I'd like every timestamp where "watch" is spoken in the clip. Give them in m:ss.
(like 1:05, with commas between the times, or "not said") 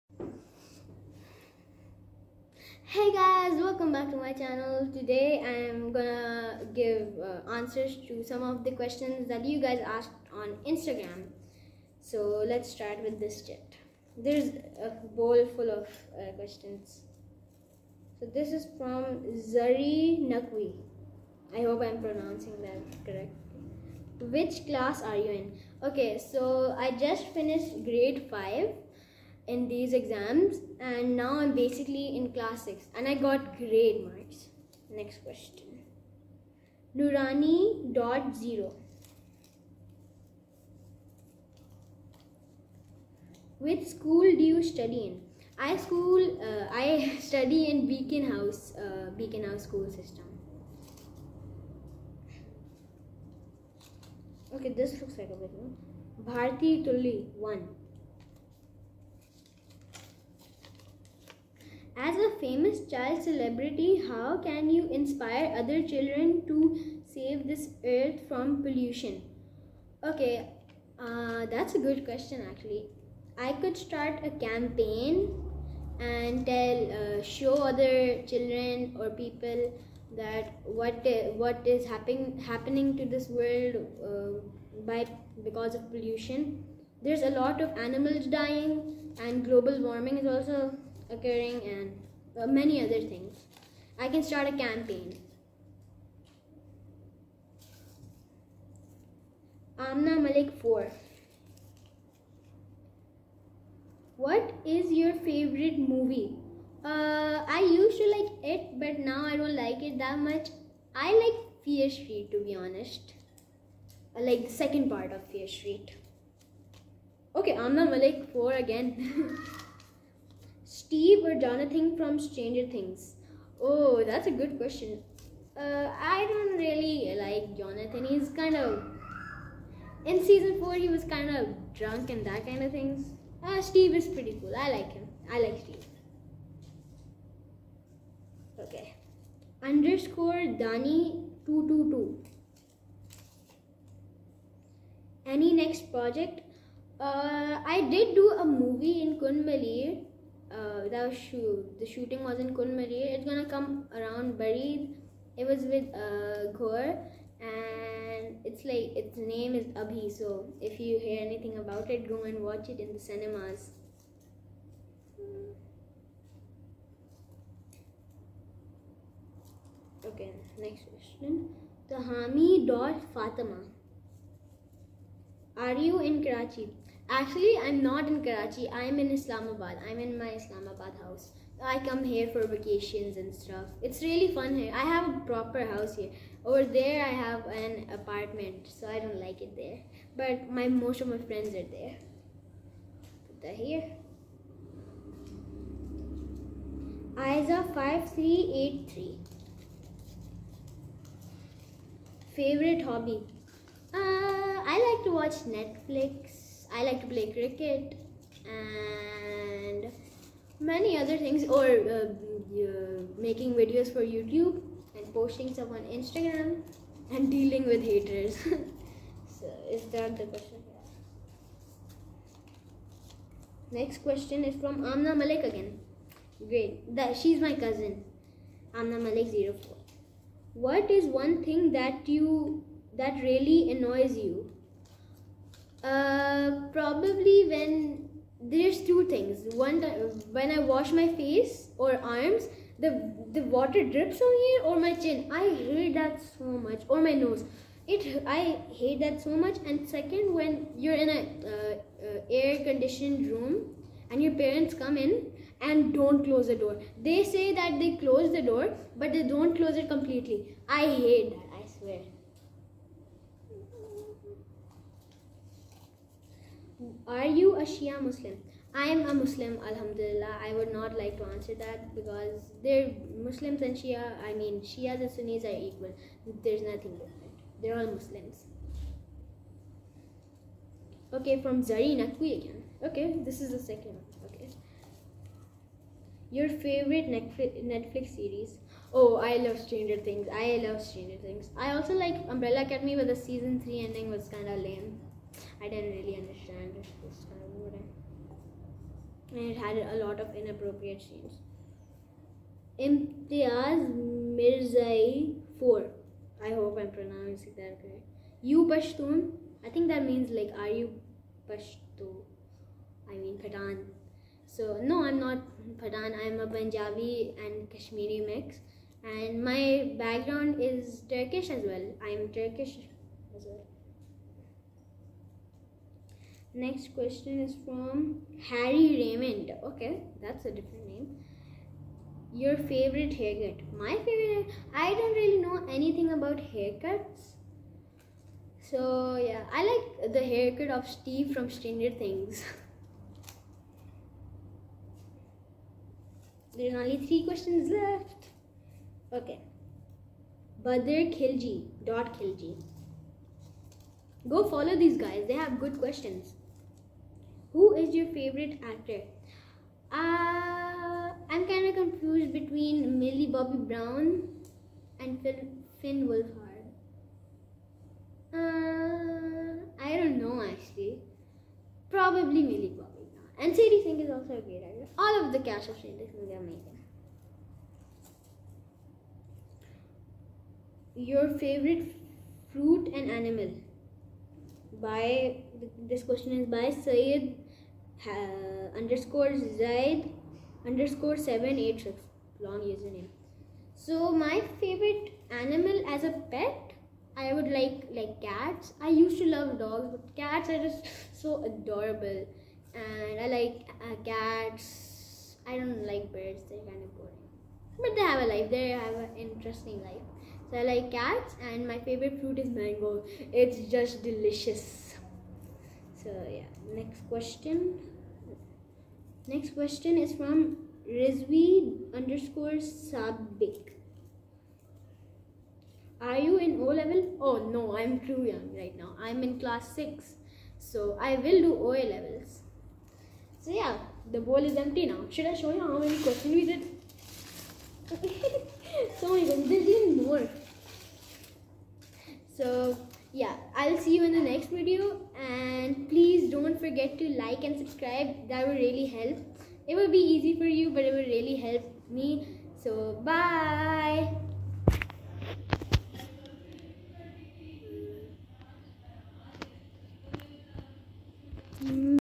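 2:42, 3:25.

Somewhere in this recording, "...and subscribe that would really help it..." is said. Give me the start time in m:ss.
7:27.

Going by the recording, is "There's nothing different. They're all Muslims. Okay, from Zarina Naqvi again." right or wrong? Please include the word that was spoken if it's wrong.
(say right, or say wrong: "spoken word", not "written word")
right.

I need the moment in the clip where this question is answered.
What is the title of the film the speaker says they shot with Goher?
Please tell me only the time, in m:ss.
2:39.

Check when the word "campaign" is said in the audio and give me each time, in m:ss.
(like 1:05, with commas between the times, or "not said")
1:14, 1:34.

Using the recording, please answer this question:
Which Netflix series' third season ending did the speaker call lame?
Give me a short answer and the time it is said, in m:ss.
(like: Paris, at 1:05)
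Umbrella Academy, at 4:52.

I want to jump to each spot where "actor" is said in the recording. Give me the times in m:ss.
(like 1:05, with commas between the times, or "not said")
5:58, 6:14.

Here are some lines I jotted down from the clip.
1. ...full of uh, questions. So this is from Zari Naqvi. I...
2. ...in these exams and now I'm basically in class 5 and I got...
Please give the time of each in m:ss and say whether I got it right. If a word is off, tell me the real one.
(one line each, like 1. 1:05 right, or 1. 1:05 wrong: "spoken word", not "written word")
1. 0:15 right
2. 0:29 wrong: "6", not "5".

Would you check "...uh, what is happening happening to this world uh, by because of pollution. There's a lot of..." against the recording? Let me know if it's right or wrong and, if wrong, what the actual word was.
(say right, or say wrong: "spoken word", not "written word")
right.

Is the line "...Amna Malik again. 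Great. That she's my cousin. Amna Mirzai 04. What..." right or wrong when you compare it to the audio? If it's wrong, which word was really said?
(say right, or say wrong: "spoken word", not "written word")
wrong: "Malik", not "Mirzai".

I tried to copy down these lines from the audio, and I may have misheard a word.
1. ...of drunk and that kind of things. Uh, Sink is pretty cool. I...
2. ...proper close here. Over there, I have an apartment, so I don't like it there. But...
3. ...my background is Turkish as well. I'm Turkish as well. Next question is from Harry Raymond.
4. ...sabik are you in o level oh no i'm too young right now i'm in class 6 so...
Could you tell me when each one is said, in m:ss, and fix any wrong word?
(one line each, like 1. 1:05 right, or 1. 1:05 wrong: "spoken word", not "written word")
1. 2:11 wrong: "Steve", not "Sink"
2. 3:05 wrong: "house", not "close"
3. 5:19 right
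4. 7:02 right.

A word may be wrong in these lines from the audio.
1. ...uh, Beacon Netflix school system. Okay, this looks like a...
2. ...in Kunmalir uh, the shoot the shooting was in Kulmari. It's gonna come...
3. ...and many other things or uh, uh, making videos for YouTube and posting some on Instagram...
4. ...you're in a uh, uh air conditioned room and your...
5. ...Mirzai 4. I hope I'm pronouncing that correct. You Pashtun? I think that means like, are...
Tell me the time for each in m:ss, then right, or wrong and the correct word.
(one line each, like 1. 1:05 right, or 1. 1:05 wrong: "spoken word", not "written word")
1. 0:48 wrong: "House", not "Netflix"
2. 2:29 right
3. 3:28 right
4. 4:10 right
5. 5:04 right.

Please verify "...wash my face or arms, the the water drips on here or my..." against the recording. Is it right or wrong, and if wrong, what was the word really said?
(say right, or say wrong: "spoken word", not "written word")
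right.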